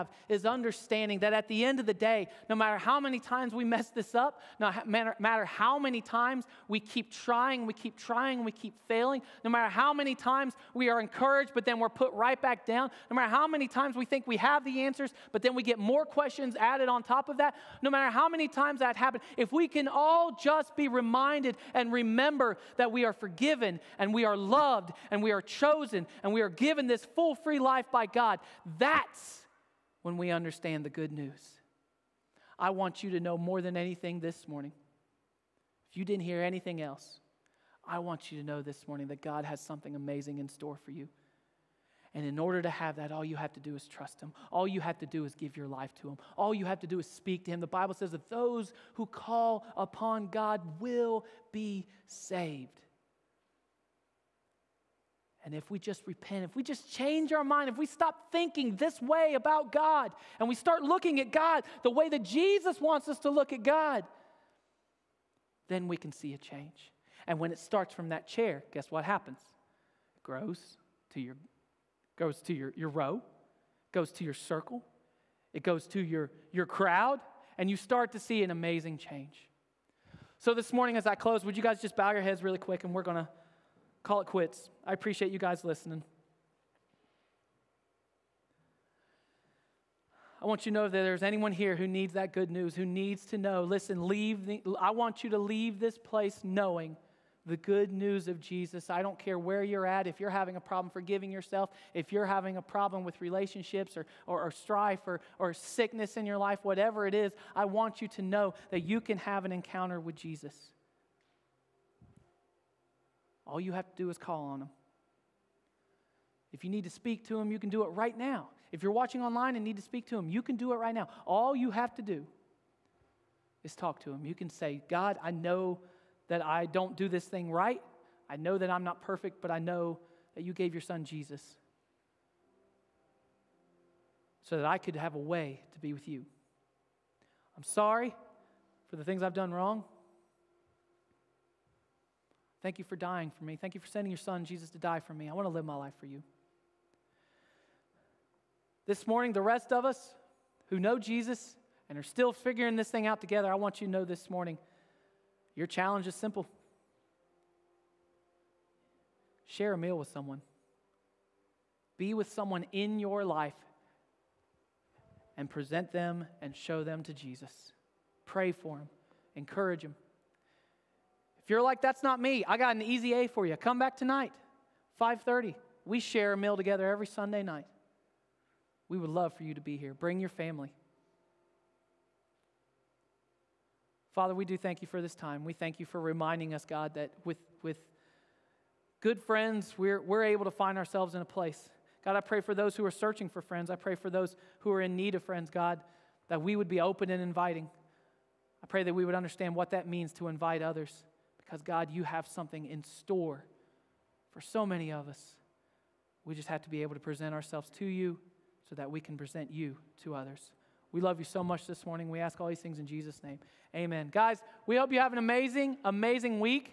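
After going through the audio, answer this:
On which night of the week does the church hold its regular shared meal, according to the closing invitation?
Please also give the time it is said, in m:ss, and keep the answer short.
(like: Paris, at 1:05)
Sunday, at 2:57.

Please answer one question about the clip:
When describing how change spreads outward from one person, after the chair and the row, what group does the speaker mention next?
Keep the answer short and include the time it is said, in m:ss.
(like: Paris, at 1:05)
circle, at 1:14.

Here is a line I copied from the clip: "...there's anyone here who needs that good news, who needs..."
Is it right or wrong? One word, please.
right.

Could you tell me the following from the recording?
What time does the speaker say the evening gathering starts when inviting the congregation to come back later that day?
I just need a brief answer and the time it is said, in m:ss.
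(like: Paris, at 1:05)
5:30, at 2:54.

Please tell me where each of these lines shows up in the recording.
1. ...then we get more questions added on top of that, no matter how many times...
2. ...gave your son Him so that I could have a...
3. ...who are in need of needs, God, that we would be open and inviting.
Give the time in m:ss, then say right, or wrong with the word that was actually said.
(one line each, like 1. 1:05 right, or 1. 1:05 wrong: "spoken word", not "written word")
1. 0:15 right
2. 2:10 wrong: "Jesus", not "Him"
3. 3:14 wrong: "friends", not "needs".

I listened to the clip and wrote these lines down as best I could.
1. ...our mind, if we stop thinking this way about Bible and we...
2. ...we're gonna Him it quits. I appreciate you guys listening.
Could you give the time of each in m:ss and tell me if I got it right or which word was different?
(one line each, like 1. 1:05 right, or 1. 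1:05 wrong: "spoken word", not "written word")
1. 0:57 wrong: "God", not "Bible"
2. 1:22 wrong: "Call", not "Him".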